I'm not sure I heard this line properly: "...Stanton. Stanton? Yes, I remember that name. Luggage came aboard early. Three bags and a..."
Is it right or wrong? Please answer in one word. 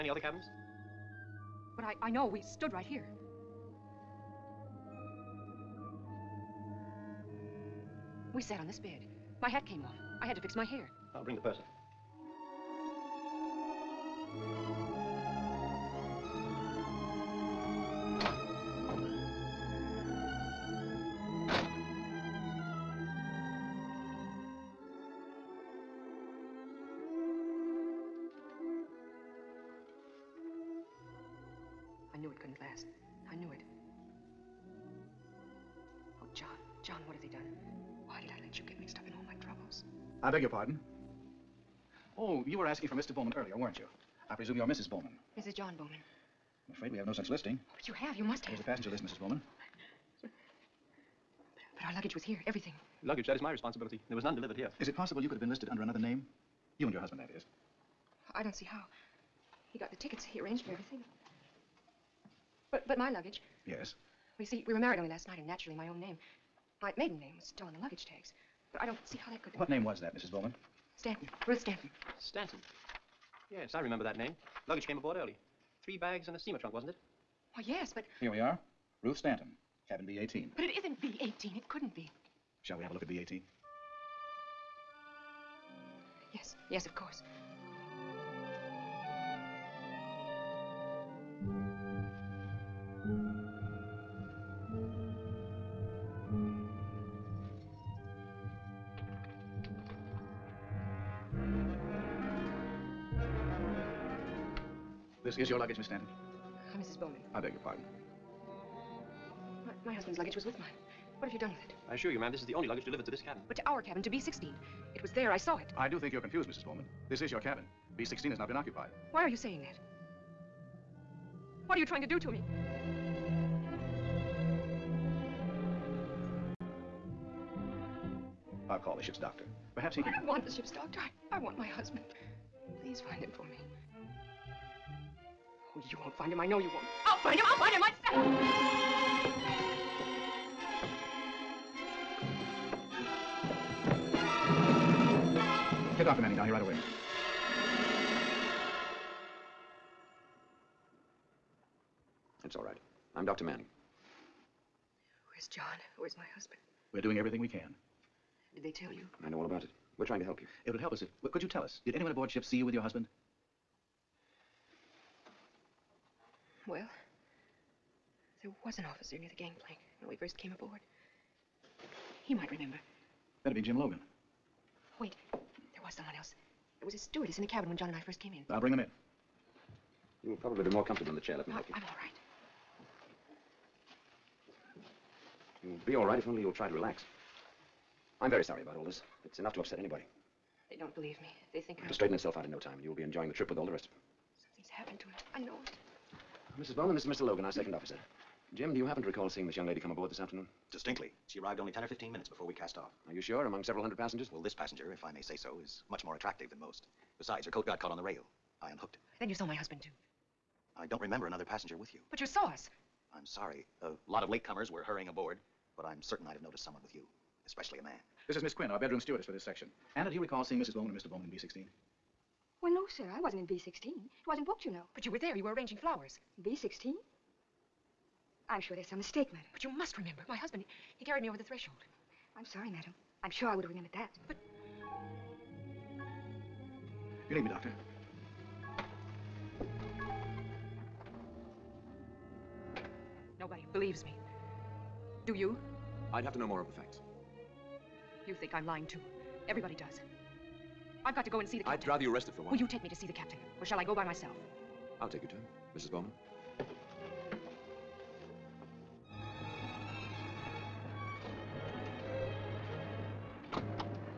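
right.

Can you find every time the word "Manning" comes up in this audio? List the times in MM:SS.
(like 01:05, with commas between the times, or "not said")
02:26, 02:33.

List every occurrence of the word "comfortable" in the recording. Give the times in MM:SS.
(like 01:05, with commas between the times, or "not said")
03:00.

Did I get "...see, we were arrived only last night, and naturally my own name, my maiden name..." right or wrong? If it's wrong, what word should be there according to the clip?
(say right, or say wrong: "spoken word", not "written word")
wrong: "married", not "arrived".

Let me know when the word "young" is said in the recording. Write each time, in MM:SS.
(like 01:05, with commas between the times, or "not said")
03:19.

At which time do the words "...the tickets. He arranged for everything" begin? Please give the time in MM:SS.
00:59.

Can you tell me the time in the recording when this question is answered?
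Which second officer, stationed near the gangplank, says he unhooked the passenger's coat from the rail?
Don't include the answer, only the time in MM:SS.
02:53.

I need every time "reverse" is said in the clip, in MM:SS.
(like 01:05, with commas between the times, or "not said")
not said.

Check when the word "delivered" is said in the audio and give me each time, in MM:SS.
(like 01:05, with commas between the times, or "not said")
00:54, 01:52.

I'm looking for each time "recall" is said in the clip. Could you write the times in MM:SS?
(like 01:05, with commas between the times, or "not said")
03:19, 03:40.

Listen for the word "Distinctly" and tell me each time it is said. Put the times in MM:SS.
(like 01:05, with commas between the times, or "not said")
03:20.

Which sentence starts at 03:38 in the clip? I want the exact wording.
This is Miss Quinn, our bedroom stewardess for this section.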